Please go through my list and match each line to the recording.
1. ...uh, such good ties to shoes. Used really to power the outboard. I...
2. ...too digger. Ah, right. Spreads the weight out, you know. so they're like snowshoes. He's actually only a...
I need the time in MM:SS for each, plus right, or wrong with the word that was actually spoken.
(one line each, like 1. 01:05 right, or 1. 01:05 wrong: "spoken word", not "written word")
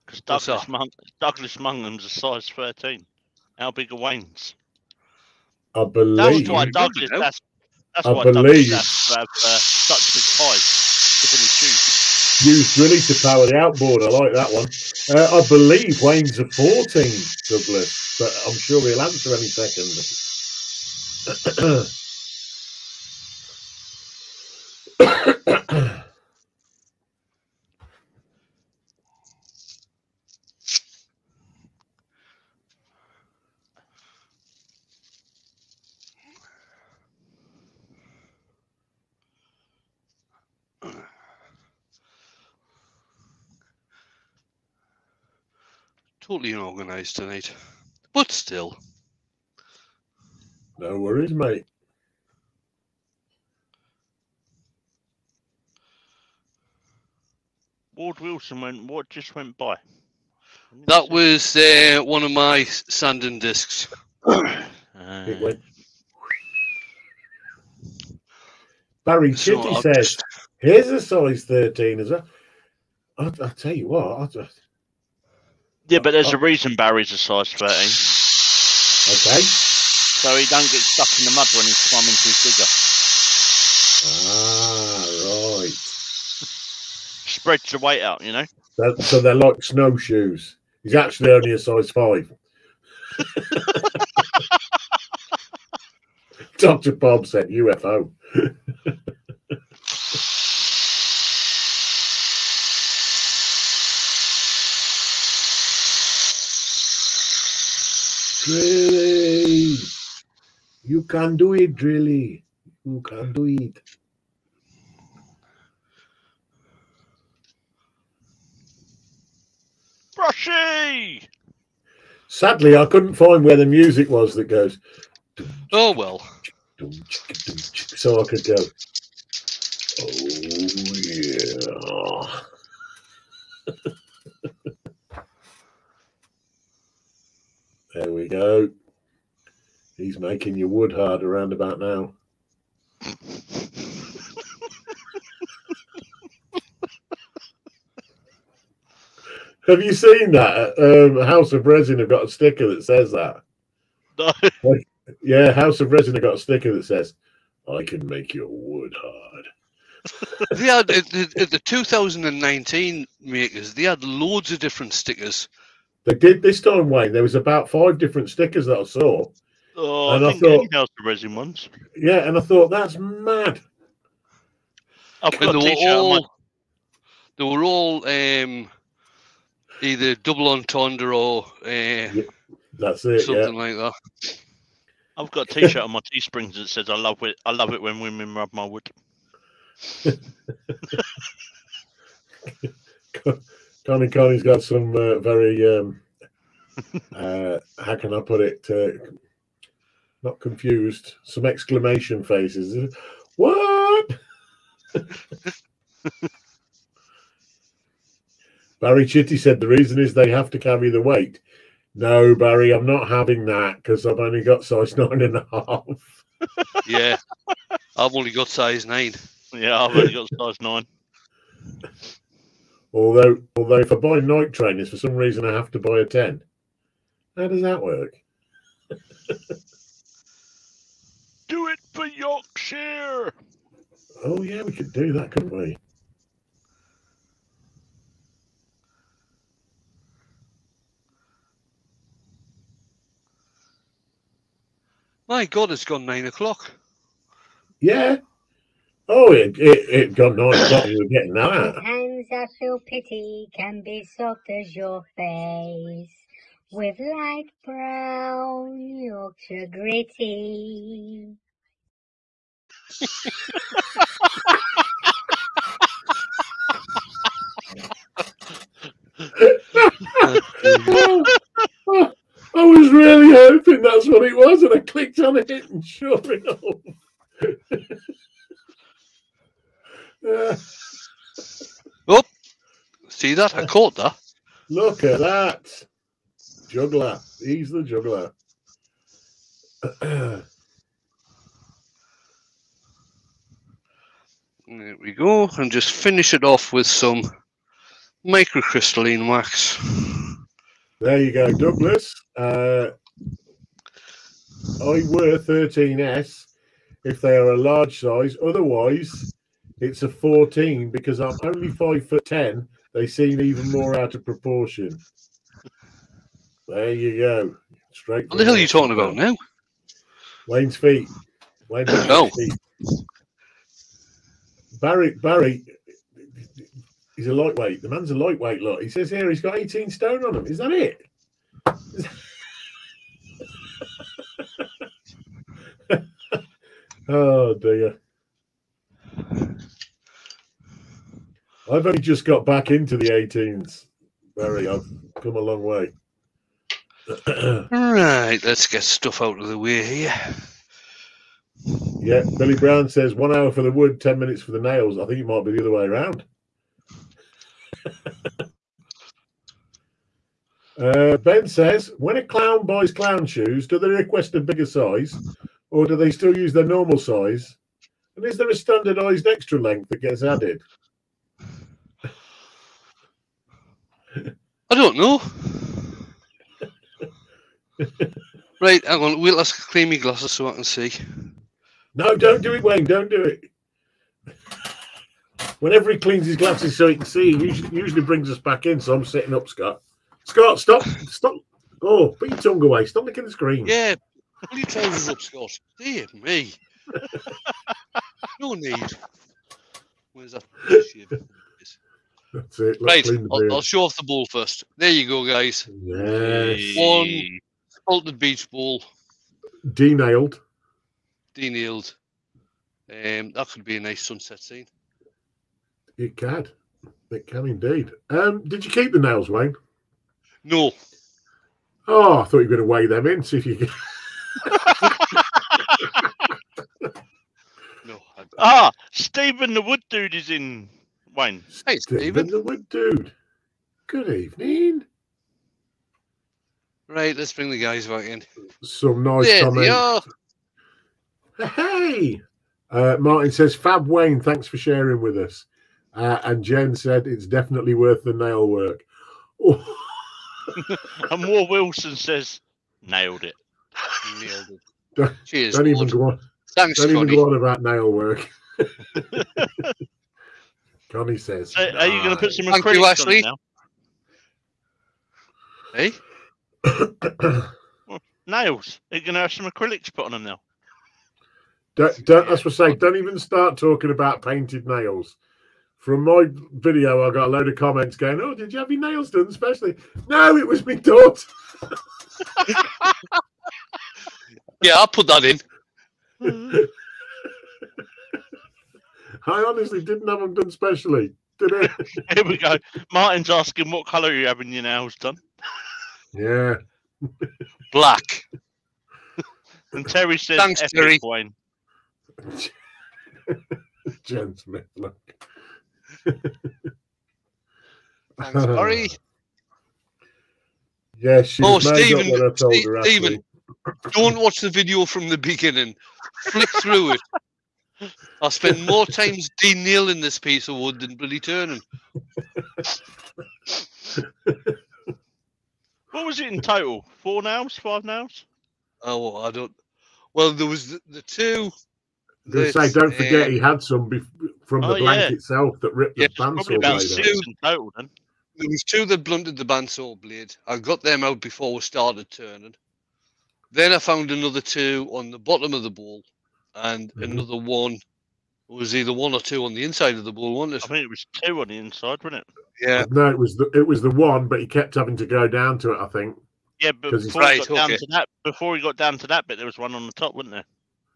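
1. 00:09 right
2. 01:22 right.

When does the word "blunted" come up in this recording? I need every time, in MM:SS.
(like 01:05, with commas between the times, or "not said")
08:59.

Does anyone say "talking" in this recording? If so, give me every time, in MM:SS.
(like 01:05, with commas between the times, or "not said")
05:18, 07:53.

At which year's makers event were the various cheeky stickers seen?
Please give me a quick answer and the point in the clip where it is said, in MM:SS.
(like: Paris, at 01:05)
2019, at 02:40.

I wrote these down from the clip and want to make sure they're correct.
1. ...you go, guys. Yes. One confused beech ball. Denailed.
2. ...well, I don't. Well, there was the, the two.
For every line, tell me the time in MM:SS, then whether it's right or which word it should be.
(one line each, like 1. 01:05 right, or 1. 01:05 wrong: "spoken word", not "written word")
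1. 06:44 wrong: "altered", not "confused"
2. 08:48 right.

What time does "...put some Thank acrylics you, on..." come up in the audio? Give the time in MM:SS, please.
07:42.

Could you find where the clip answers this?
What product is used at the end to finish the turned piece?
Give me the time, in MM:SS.
04:56.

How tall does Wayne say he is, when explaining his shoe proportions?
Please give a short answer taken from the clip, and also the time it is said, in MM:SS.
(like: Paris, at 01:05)
5 foot 10, at 05:11.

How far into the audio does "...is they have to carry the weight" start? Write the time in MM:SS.
03:29.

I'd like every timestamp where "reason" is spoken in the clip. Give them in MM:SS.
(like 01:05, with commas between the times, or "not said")
01:16, 03:29, 03:45.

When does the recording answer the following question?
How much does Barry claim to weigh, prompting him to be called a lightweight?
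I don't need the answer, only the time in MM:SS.
05:29.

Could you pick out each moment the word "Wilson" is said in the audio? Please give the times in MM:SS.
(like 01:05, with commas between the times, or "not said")
00:58, 07:31.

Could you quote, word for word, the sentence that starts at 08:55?
itself that ripped yeah, the bandsaw blade.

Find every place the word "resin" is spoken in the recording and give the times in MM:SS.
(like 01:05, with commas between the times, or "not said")
02:31, 02:35, 02:51.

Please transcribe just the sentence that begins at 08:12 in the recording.
Martin's asking what colour are you having your nails done?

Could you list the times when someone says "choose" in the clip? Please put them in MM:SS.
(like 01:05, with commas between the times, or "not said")
not said.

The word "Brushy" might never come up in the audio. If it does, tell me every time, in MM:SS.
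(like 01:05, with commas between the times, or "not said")
02:00.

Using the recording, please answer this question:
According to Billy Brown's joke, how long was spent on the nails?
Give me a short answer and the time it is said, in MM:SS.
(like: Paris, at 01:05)
10 minutes, at 05:53.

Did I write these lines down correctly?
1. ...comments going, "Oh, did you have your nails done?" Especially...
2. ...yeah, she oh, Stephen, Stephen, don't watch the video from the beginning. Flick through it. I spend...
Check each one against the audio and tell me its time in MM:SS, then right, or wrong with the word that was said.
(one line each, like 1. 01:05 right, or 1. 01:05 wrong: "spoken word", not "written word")
1. 07:57 right
2. 08:30 right.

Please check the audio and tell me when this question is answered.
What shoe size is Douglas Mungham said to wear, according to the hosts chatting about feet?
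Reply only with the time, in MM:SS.
00:01.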